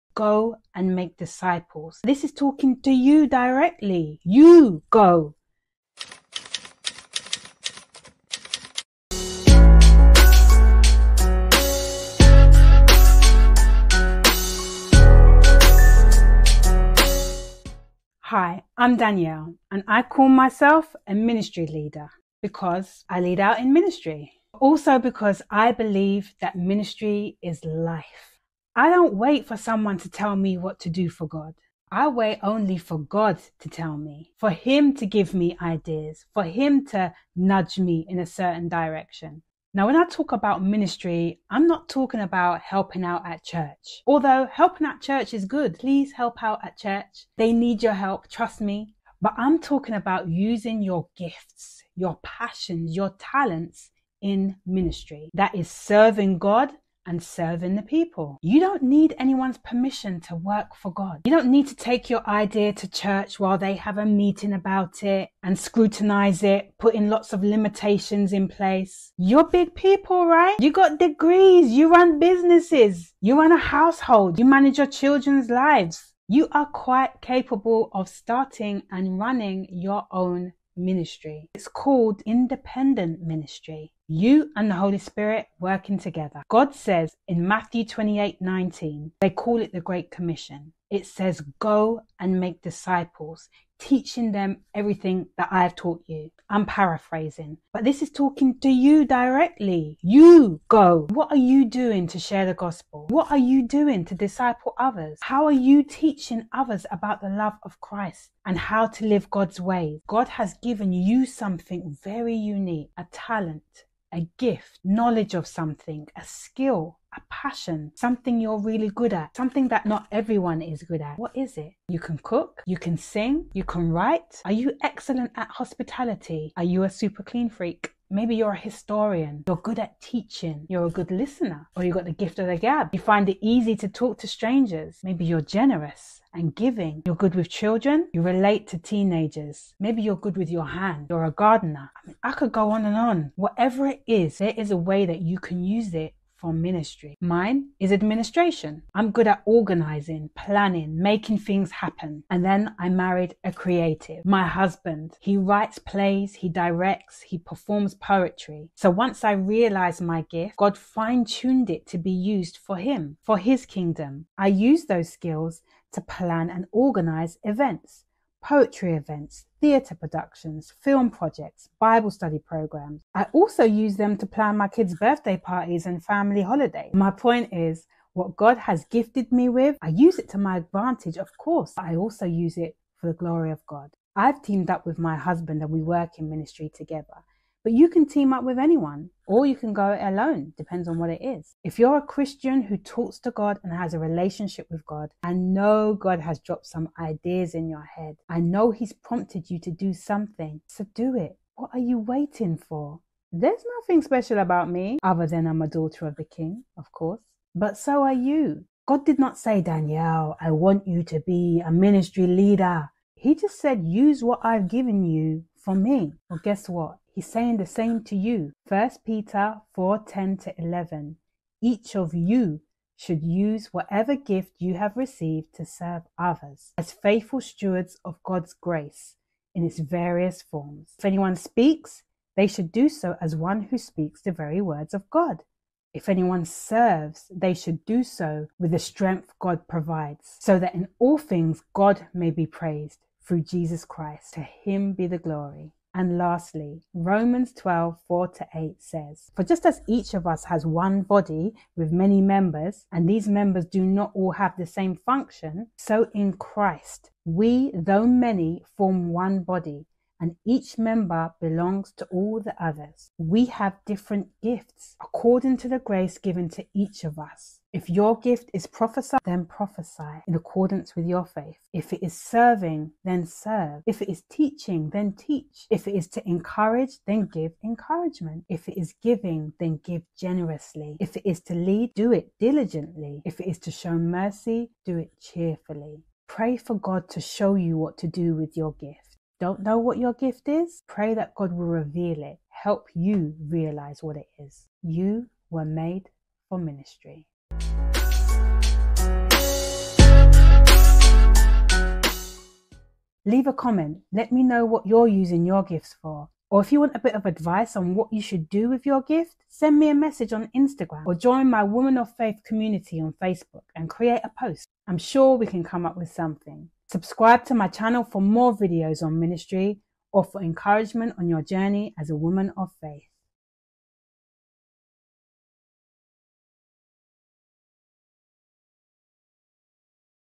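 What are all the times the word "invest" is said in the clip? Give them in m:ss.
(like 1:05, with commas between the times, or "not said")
not said.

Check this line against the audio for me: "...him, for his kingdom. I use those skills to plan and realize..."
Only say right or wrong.
wrong.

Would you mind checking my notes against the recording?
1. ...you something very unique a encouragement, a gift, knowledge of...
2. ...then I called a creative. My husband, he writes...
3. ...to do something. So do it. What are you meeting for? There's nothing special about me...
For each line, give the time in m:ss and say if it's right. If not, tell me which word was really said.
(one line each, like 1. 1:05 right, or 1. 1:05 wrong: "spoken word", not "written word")
1. 1:50 wrong: "talent", not "encouragement"
2. 2:32 wrong: "married", not "called"
3. 3:19 wrong: "waiting", not "meeting".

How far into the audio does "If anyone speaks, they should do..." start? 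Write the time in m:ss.
3:50.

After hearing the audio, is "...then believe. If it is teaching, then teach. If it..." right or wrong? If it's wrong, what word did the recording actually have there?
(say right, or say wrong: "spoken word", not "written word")
wrong: "serve", not "believe".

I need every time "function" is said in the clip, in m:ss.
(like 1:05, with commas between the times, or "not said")
4:14.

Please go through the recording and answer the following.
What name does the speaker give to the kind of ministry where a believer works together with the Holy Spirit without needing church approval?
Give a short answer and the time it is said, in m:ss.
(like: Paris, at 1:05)
Independent ministry, at 1:22.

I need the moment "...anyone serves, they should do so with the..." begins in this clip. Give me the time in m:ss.
3:56.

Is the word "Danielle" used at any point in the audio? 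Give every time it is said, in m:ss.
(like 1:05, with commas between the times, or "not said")
0:18, 3:29.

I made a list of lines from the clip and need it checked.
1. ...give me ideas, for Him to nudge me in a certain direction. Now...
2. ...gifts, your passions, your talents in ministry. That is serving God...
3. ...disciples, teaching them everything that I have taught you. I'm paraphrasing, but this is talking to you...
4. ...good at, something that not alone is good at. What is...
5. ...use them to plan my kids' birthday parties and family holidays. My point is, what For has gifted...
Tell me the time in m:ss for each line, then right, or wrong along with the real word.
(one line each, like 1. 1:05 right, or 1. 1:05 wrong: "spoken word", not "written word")
1. 0:35 right
2. 0:51 right
3. 1:32 right
4. 1:58 wrong: "everyone", not "alone"
5. 2:53 wrong: "God", not "For".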